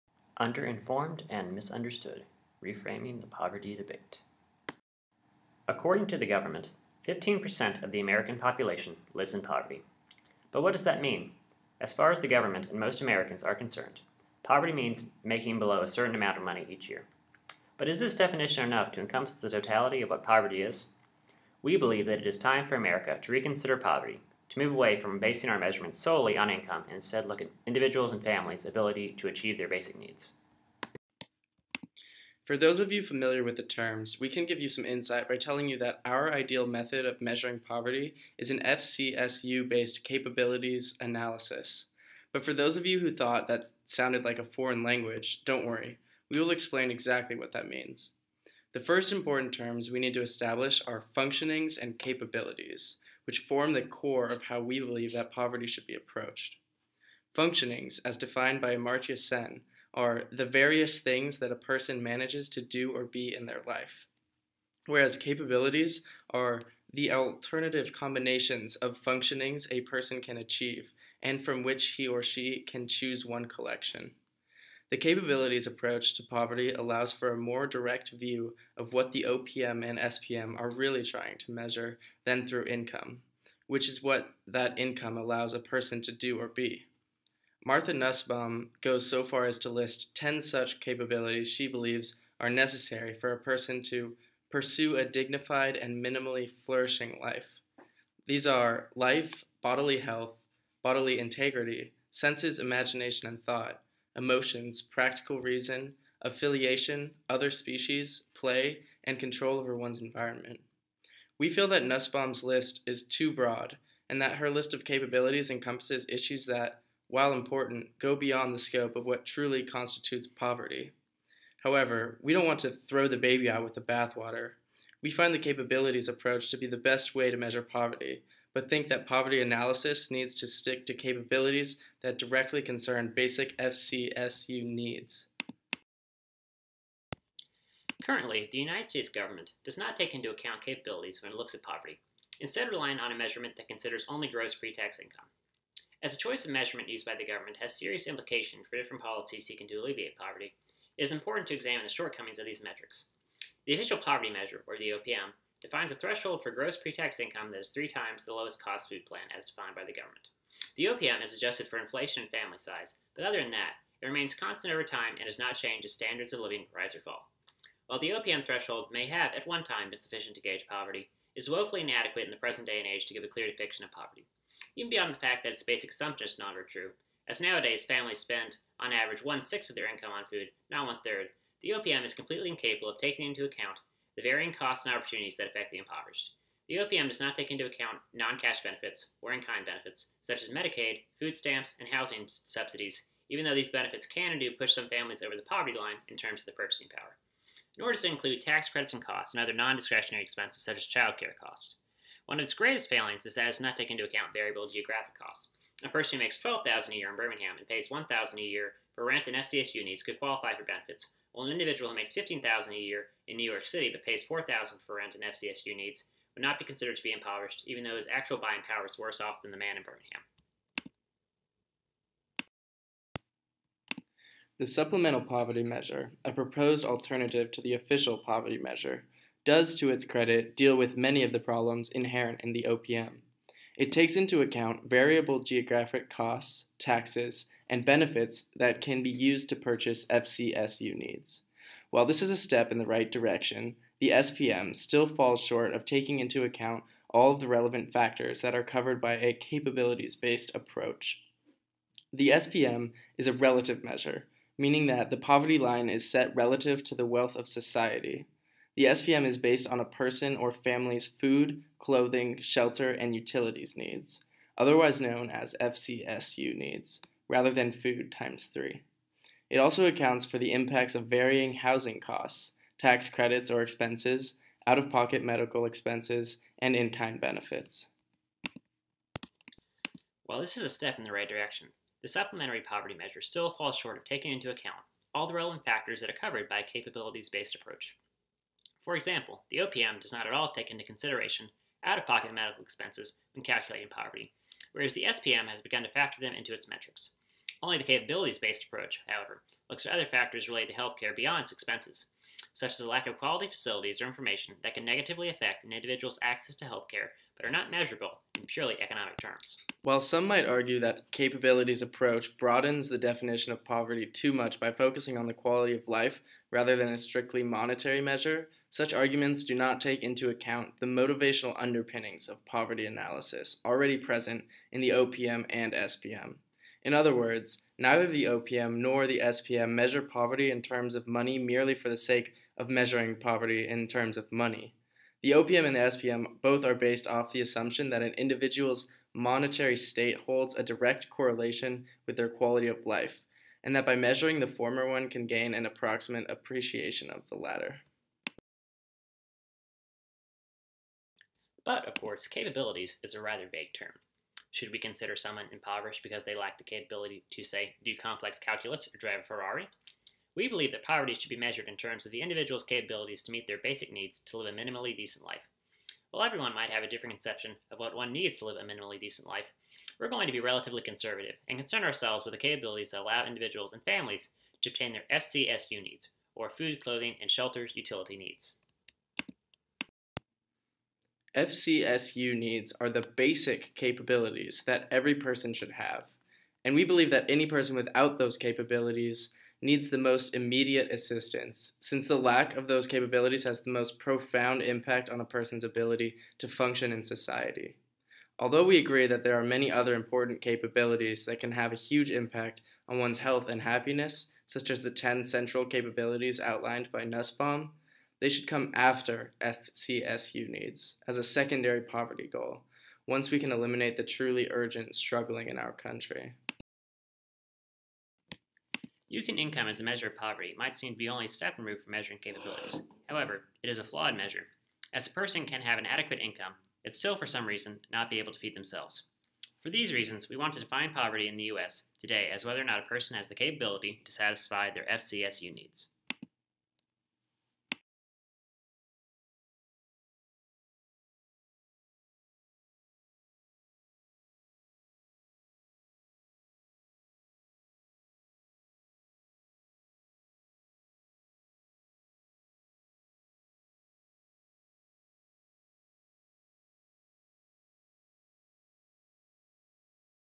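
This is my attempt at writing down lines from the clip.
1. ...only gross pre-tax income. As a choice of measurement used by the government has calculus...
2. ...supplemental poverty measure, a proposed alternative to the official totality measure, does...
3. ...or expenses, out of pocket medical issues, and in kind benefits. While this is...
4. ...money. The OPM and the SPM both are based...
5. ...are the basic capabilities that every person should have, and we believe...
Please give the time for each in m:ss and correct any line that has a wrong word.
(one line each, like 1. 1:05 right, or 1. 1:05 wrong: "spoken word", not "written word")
1. 2:24 wrong: "serious", not "calculus"
2. 3:44 wrong: "poverty", not "totality"
3. 4:33 wrong: "expenses", not "issues"
4. 5:34 right
5. 6:22 right.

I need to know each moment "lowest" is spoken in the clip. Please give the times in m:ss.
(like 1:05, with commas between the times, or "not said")
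2:38.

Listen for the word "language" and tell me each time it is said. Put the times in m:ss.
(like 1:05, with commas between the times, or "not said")
0:44.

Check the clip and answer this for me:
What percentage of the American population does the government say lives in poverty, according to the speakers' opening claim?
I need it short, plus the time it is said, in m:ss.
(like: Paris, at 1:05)
15%, at 0:07.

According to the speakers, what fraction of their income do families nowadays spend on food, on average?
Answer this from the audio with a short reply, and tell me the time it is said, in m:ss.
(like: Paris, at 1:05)
one sixth, at 2:59.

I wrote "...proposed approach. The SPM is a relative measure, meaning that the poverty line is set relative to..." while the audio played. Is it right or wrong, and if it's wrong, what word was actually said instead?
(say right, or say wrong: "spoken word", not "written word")
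wrong: "based", not "proposed".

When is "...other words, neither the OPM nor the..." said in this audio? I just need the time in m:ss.
5:26.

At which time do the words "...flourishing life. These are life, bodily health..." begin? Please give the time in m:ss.
1:36.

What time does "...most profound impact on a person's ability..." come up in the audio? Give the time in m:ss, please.
6:33.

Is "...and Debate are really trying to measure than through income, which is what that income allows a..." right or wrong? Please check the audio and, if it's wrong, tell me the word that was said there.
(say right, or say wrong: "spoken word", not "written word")
wrong: "SPM", not "Debate".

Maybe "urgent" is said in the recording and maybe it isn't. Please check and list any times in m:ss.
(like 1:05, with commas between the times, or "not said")
6:54.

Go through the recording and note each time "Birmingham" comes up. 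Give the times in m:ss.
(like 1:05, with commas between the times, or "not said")
3:27, 3:39.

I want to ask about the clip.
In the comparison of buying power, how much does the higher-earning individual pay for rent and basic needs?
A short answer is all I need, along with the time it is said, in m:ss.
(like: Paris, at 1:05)
$4,000, at 3:34.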